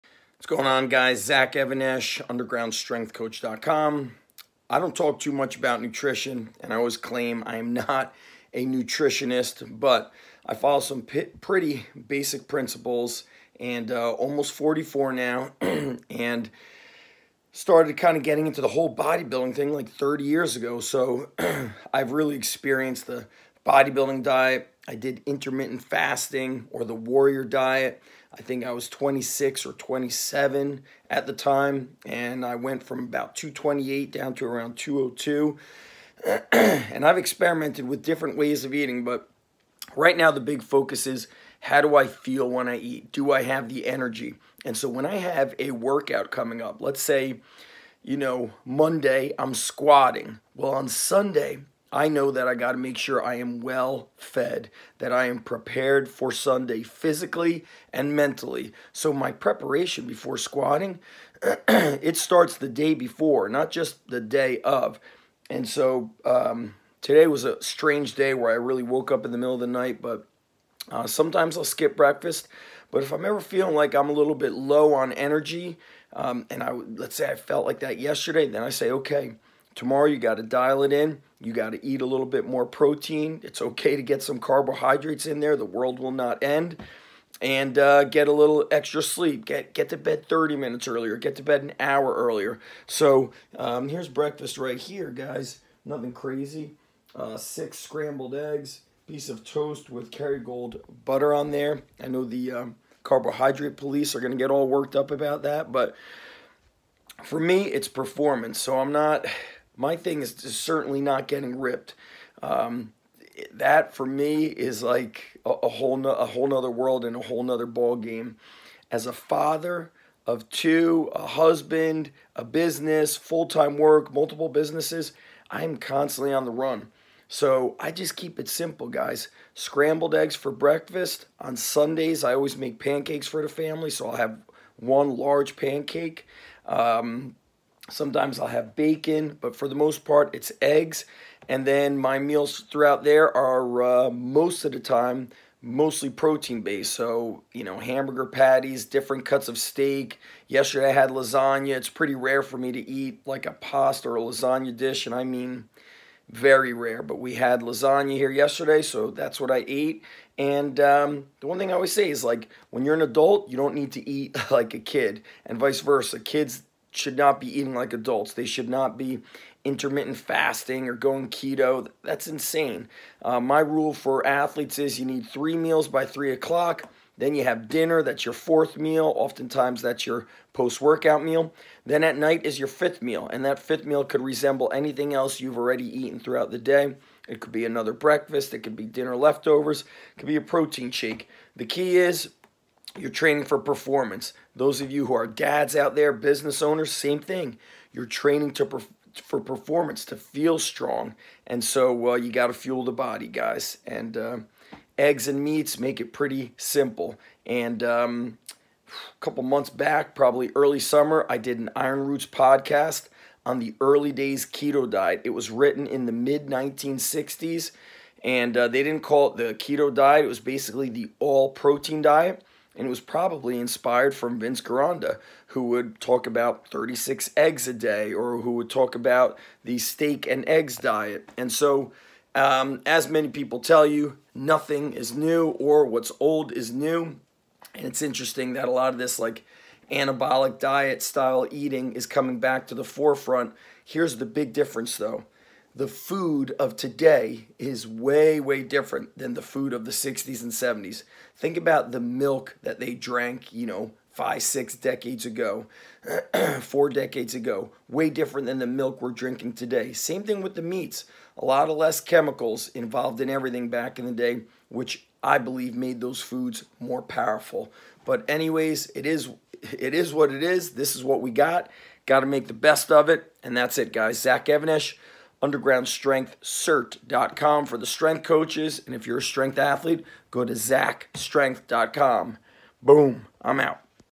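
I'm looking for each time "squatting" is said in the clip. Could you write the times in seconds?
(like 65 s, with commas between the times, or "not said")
49 s, 60 s.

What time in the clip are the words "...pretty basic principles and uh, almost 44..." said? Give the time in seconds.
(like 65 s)
11 s.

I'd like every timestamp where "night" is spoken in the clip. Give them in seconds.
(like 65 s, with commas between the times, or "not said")
69 s, 182 s.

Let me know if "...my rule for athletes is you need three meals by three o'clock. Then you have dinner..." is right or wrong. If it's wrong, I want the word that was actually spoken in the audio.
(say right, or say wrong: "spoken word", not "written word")
right.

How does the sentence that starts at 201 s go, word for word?
And so uh, you got to fuel the body, guys.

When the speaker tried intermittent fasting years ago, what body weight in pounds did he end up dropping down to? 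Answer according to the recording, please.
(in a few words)
202.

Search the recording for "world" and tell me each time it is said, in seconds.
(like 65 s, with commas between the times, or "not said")
85 s, 116 s.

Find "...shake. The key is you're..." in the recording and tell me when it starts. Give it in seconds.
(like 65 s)
190 s.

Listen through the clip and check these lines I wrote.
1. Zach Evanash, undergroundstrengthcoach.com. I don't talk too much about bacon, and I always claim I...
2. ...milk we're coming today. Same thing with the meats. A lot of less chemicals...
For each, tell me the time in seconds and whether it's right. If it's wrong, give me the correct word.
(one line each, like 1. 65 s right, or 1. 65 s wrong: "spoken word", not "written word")
1. 1 s wrong: "nutrition", not "bacon"
2. 258 s wrong: "drinking", not "coming".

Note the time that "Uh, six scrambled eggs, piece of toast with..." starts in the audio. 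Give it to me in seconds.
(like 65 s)
97 s.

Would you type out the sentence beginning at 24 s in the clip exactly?
I did intermittent fasting or the warrior diet.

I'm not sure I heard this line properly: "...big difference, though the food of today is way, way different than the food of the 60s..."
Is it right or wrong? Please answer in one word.
right.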